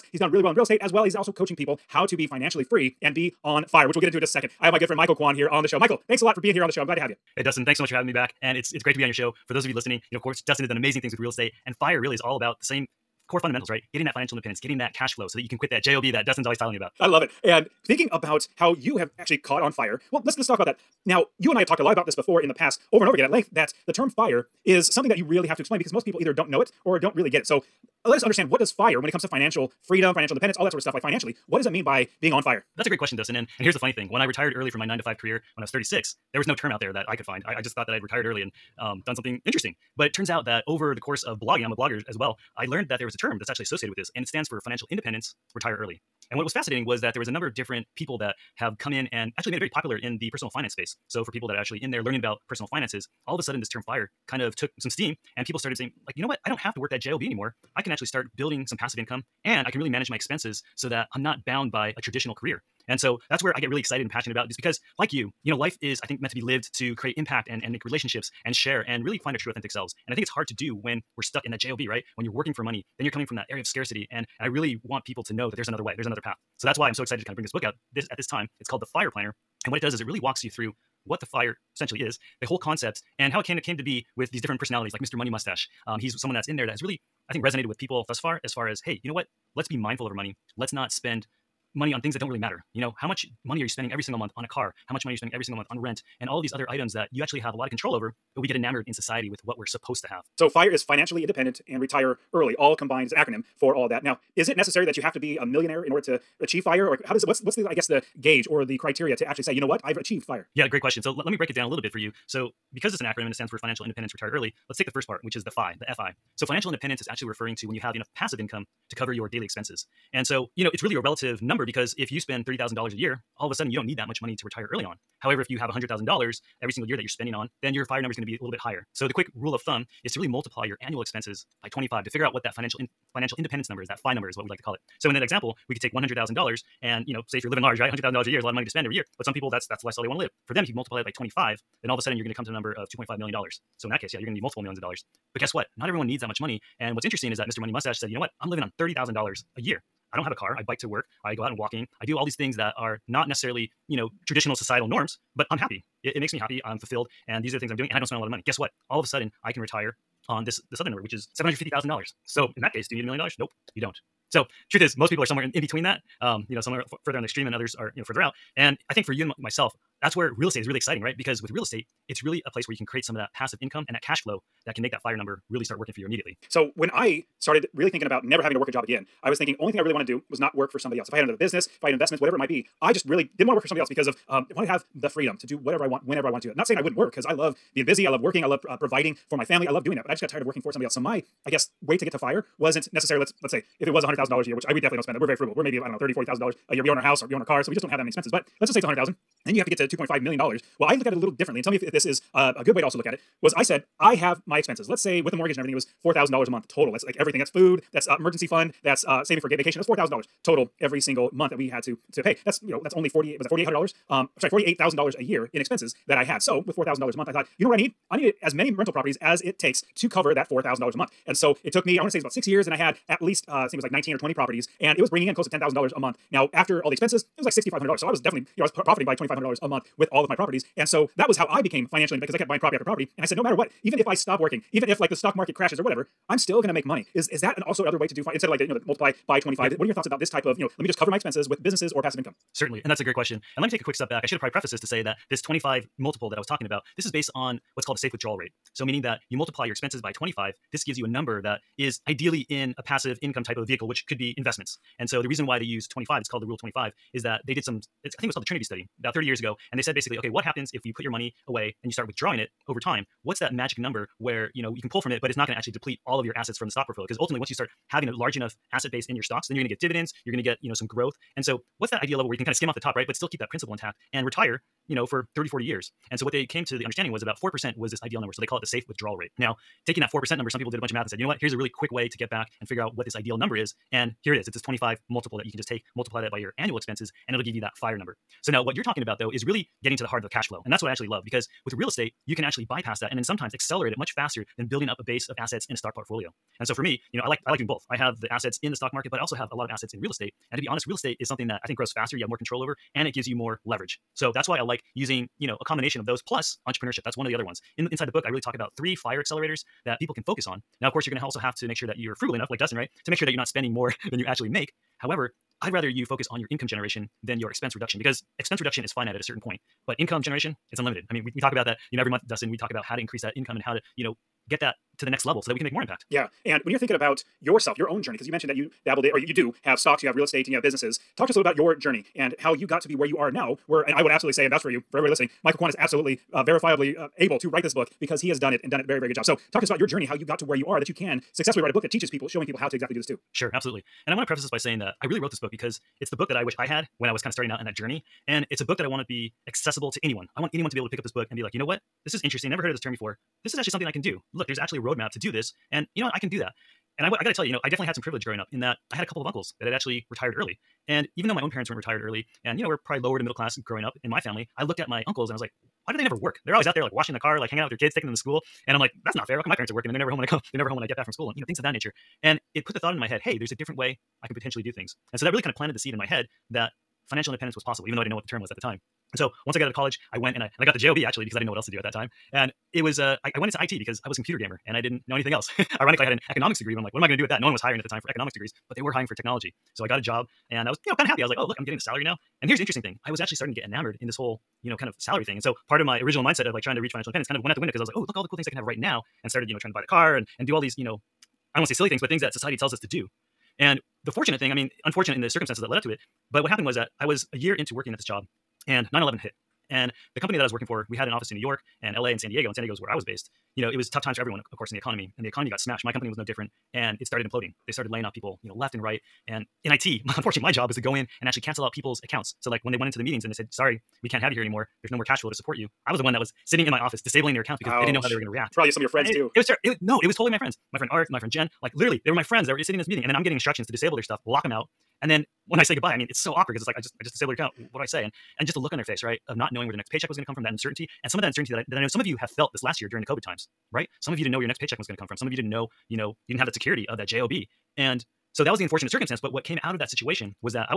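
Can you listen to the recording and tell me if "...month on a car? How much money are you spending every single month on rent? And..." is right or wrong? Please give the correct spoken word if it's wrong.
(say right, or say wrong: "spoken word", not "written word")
right.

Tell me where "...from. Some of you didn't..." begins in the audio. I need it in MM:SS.
07:25.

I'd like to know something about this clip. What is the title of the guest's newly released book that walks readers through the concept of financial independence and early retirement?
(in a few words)
The Fire Planner.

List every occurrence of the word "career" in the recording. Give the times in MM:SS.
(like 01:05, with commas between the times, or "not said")
00:35, 01:02.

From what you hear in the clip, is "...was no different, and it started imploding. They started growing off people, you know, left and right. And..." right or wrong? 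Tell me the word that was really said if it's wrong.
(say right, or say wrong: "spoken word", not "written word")
wrong: "laying", not "growing".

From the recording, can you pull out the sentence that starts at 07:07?
they didn't know how they were going to react.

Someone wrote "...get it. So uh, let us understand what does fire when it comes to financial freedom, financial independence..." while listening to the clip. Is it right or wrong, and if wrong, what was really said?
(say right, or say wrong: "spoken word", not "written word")
right.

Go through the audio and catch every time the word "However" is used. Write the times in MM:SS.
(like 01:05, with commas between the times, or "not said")
02:05, 05:14.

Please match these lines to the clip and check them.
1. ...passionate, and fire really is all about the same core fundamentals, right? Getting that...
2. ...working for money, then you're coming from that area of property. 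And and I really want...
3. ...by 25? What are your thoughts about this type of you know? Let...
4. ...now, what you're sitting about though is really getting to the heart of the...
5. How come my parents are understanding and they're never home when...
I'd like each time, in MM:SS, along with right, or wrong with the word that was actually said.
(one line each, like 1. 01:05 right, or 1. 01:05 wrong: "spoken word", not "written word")
1. 00:11 wrong: "estate", not "passionate"
2. 01:12 wrong: "scarcity", not "property"
3. 03:59 right
4. 04:48 wrong: "talking", not "sitting"
5. 06:09 wrong: "working", not "understanding".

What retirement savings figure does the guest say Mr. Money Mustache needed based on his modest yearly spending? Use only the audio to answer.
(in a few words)
$750,000.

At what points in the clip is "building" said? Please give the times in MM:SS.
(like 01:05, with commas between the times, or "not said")
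00:58, 04:54.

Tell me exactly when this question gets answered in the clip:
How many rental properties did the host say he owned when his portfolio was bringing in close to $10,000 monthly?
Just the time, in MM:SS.
03:43.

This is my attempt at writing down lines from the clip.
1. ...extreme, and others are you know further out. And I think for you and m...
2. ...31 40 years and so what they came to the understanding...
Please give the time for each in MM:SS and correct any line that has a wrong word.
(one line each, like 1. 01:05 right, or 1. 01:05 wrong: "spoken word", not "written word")
1. 02:47 right
2. 04:35 wrong: "30", not "31".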